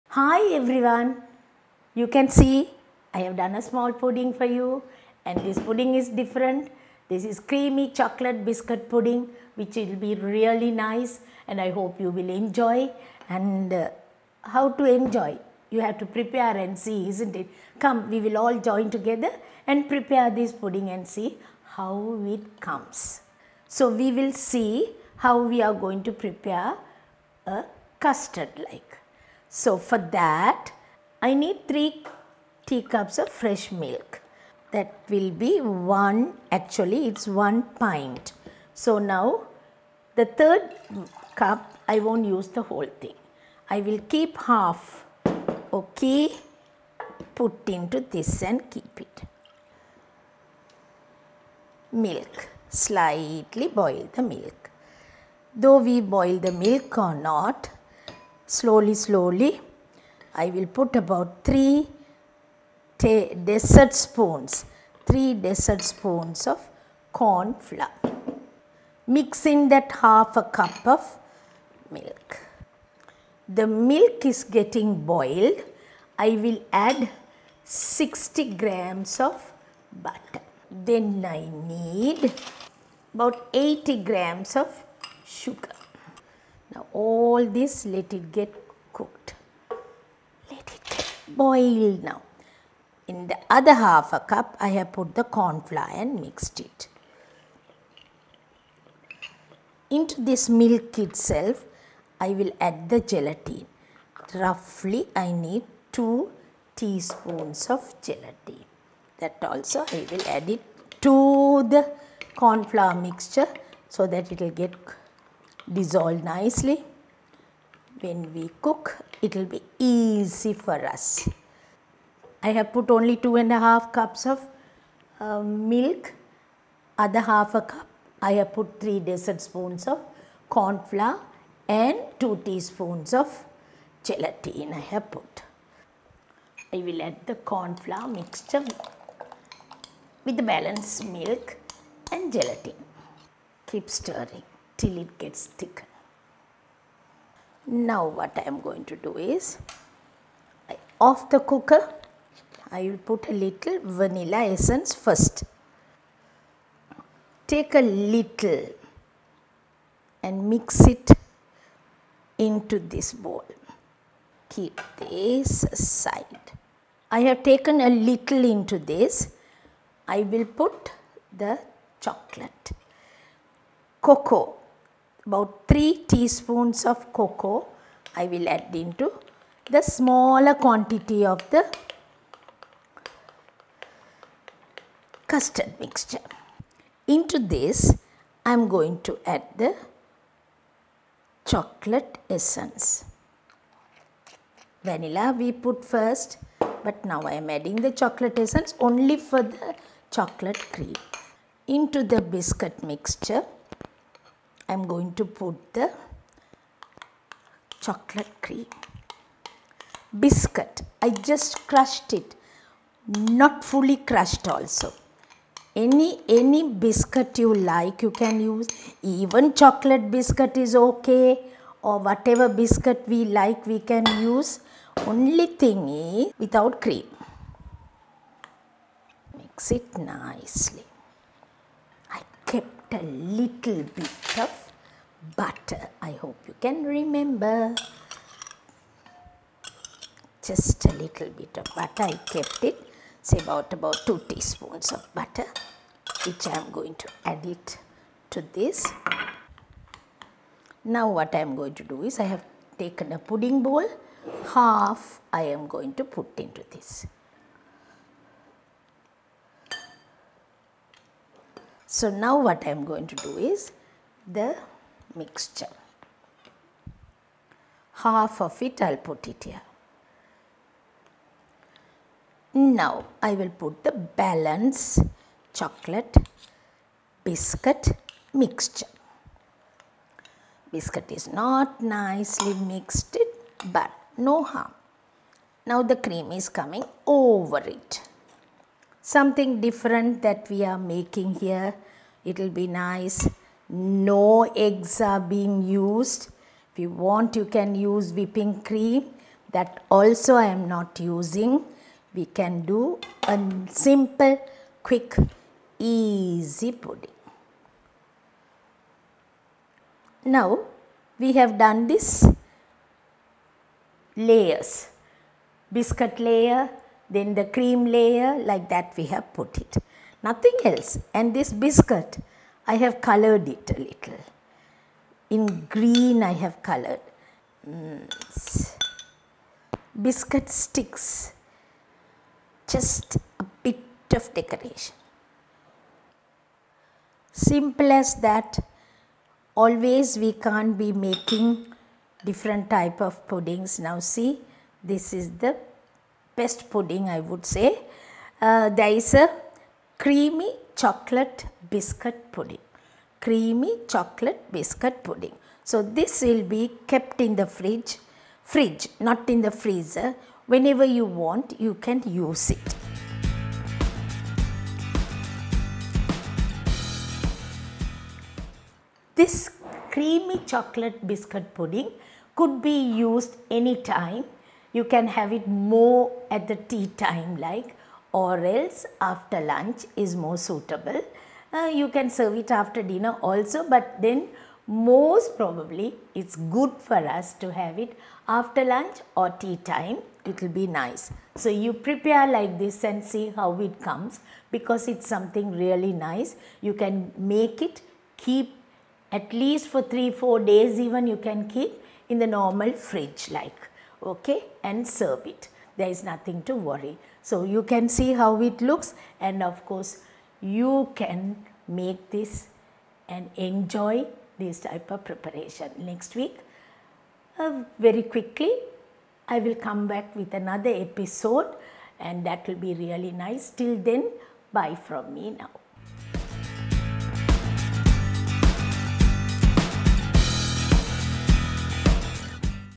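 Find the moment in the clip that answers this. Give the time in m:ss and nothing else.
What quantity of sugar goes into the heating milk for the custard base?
1:23.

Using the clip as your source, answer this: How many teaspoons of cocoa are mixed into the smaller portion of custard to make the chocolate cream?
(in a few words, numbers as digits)
3 teaspoons.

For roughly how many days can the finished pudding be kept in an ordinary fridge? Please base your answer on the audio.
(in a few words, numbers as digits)
3-4 days.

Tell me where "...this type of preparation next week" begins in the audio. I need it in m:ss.
6:54.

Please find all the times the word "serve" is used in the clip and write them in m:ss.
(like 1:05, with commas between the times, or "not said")
6:22, 6:44.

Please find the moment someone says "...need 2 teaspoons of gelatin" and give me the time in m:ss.
1:45.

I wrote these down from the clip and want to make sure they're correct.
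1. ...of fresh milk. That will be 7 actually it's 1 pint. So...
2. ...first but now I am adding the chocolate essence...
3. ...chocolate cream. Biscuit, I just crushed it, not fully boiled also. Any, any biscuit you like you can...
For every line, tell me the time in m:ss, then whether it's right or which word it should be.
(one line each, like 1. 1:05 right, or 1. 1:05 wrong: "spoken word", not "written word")
1. 0:33 wrong: "1", not "7"
2. 3:15 right
3. 3:27 wrong: "crushed", not "boiled".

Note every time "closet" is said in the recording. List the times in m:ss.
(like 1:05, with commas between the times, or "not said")
not said.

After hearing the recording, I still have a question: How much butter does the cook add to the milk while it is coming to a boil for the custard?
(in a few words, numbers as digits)
60 grams.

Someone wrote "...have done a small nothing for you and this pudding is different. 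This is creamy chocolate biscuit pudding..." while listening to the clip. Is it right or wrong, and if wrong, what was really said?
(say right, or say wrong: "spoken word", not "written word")
wrong: "pudding", not "nothing".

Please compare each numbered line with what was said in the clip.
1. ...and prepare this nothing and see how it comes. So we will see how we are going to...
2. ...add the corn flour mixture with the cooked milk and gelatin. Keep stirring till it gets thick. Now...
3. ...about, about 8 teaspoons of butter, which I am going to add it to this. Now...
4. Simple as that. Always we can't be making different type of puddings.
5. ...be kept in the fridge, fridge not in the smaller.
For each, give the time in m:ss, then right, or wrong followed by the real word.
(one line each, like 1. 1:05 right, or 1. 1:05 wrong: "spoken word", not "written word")
1. 0:19 wrong: "pudding", not "nothing"
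2. 2:17 wrong: "balanced", not "cooked"
3. 4:03 wrong: "2", not "8"
4. 5:37 right
5. 5:56 wrong: "freezer", not "smaller".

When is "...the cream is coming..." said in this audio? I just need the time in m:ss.
4:45.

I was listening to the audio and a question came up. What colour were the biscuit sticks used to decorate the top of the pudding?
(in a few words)
Green.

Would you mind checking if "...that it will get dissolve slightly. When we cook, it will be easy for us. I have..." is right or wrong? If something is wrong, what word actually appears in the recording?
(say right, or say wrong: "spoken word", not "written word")
wrong: "nicely", not "slightly".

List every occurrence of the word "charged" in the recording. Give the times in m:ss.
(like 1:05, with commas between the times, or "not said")
not said.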